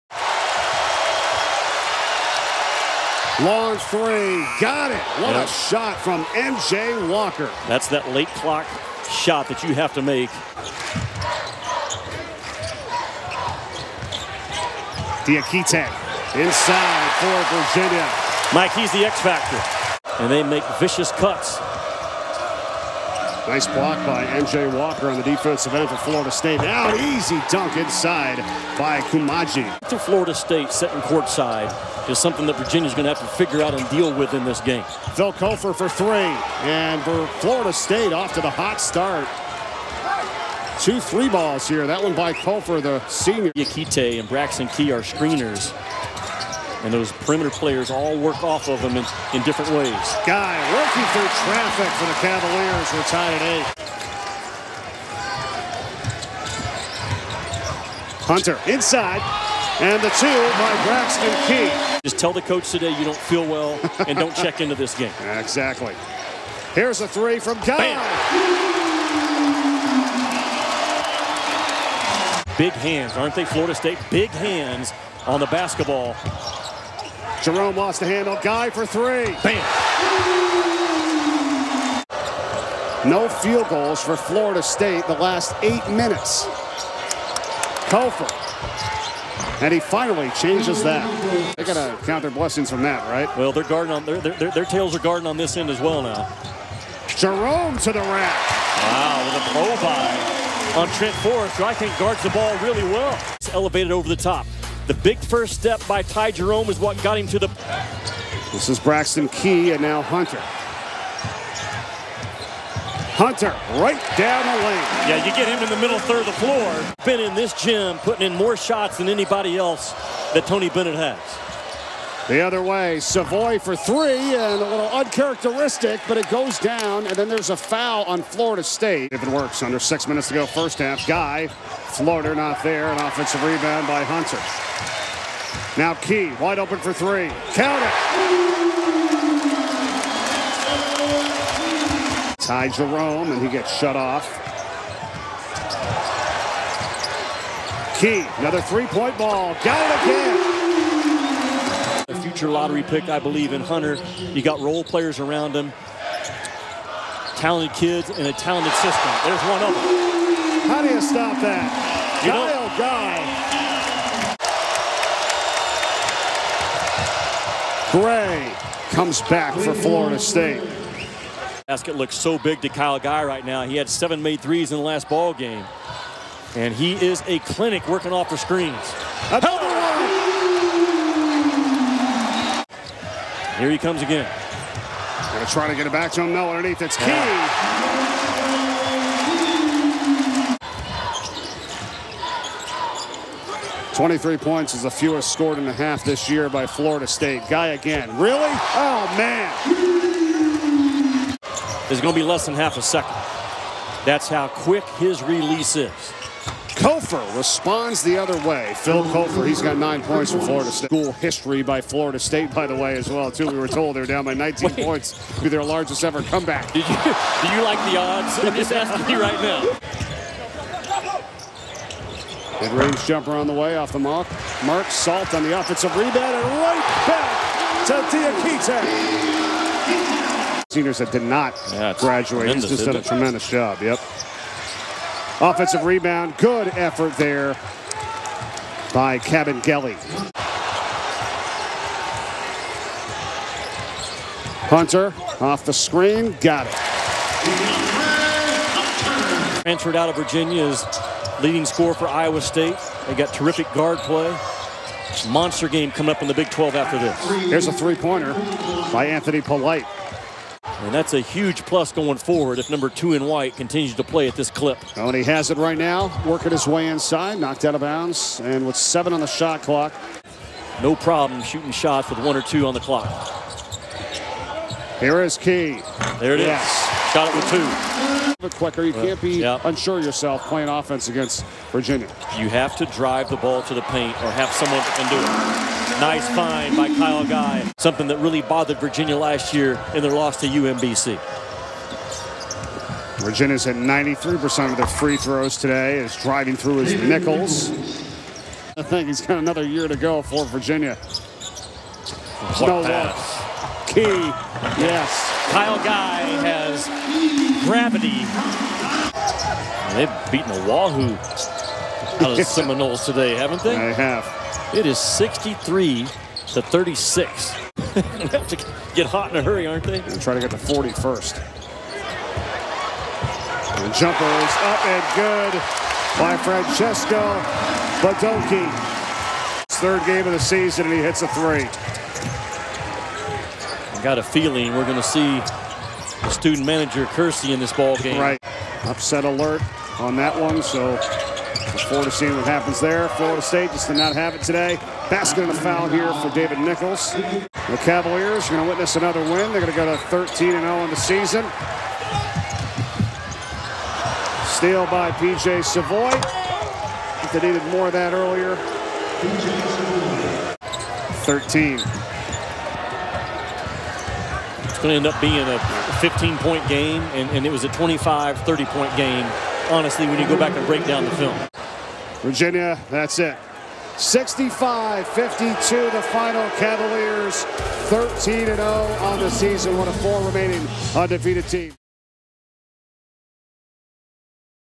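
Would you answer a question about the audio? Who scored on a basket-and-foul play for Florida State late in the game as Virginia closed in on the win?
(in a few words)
David Nichols.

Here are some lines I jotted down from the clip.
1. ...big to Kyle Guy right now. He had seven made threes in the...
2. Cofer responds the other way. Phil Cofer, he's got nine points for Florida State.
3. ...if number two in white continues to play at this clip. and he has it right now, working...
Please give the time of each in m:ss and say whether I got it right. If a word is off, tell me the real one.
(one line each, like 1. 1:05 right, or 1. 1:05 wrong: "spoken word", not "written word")
1. 2:52 right
2. 3:26 right
3. 4:22 right.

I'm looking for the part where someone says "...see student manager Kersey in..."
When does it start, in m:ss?
5:35.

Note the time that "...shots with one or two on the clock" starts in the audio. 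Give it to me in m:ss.
4:31.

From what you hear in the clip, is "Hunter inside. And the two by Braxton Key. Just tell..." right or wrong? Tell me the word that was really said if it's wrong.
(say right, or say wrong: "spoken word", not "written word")
right.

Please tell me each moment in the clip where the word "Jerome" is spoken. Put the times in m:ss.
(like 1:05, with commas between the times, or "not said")
1:17, 1:37, 1:46, 2:22.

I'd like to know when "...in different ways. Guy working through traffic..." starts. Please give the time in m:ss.
0:49.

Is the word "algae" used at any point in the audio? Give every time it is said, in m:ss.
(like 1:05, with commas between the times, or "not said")
not said.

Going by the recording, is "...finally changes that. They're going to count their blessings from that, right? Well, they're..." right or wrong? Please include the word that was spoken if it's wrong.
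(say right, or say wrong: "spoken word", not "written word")
right.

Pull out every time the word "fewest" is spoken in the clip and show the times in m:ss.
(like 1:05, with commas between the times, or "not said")
3:14.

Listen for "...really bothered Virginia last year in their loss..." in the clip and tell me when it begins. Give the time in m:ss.
4:48.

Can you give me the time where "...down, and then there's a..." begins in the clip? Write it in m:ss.
2:06.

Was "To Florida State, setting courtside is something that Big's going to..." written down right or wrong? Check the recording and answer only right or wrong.
wrong.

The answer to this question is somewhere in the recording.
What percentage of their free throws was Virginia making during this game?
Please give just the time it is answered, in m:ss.
4:53.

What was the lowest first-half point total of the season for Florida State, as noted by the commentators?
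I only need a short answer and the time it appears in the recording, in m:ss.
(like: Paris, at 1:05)
23, at 3:13.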